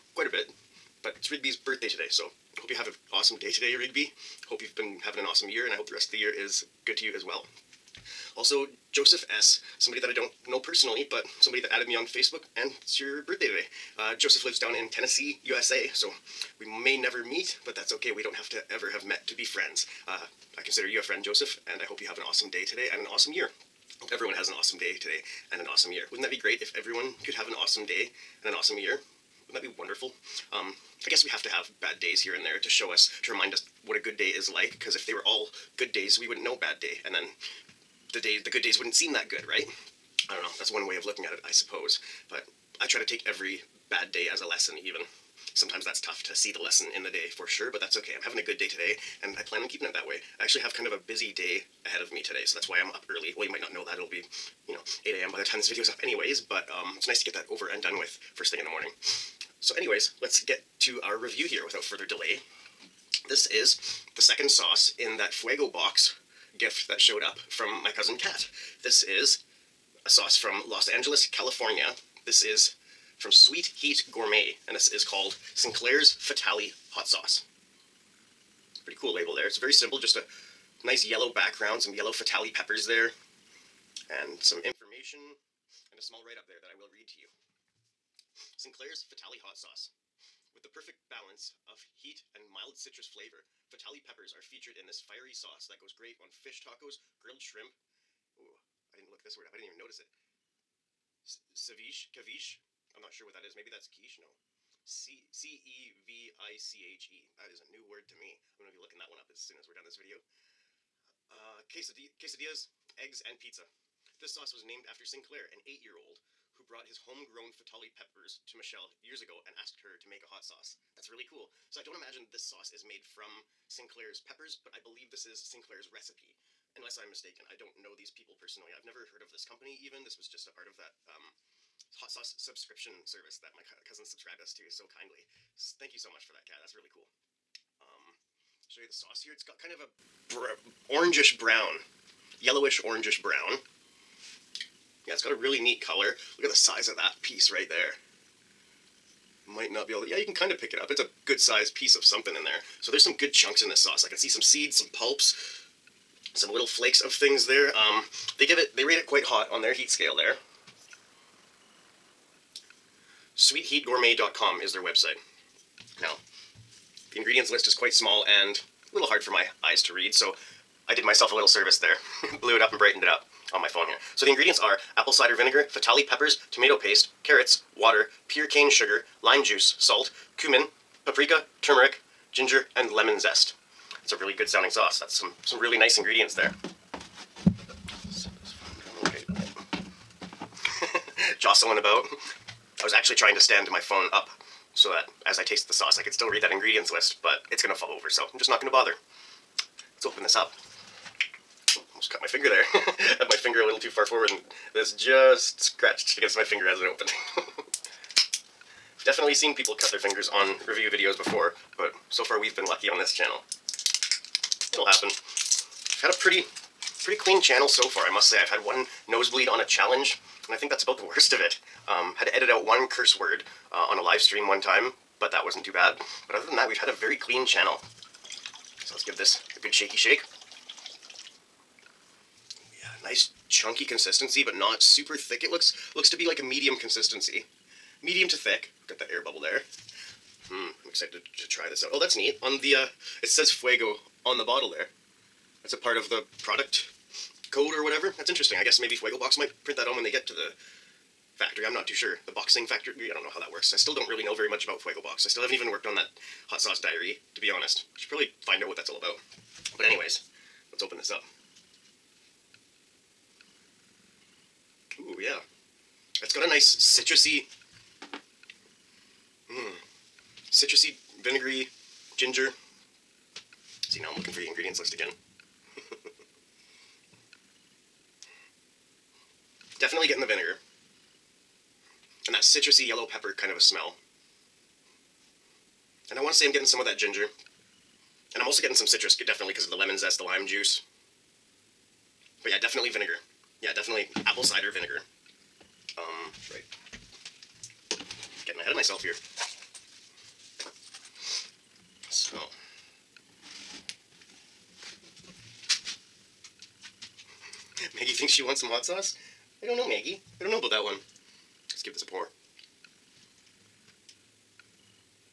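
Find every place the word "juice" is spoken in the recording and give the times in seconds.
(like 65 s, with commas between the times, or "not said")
179 s, 290 s.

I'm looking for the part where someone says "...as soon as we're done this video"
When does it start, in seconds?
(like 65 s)
109 s.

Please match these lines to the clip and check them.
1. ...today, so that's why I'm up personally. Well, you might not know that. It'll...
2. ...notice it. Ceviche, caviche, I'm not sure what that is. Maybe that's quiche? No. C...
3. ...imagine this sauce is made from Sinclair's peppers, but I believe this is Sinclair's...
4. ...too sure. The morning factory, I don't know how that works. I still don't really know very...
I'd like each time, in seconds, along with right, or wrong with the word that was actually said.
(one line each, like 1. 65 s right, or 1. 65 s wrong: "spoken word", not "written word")
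1. 52 s wrong: "early", not "personally"
2. 99 s right
3. 121 s right
4. 251 s wrong: "boxing", not "morning".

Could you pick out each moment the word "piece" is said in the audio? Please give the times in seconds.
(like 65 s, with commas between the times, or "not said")
147 s, 151 s.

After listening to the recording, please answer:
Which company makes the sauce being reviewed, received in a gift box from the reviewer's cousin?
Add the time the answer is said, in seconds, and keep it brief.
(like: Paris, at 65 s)
Sweet Heat Gourmet, at 73 s.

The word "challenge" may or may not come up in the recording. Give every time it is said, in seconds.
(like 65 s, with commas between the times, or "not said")
219 s.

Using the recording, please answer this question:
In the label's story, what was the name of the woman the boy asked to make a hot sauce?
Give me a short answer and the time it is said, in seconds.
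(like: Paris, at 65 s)
Michelle, at 118 s.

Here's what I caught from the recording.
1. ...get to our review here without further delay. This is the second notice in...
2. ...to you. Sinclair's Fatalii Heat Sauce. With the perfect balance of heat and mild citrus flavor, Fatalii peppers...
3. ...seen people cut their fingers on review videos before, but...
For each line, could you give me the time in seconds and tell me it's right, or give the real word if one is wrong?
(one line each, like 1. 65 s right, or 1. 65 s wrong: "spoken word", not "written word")
1. 60 s wrong: "sauce", not "notice"
2. 87 s wrong: "Hot", not "Heat"
3. 209 s right.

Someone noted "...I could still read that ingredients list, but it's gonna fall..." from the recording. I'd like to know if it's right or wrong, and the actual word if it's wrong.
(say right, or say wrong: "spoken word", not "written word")
right.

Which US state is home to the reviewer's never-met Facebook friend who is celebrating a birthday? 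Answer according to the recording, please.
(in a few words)
Tennessee.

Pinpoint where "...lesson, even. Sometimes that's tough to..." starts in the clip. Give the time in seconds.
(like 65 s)
44 s.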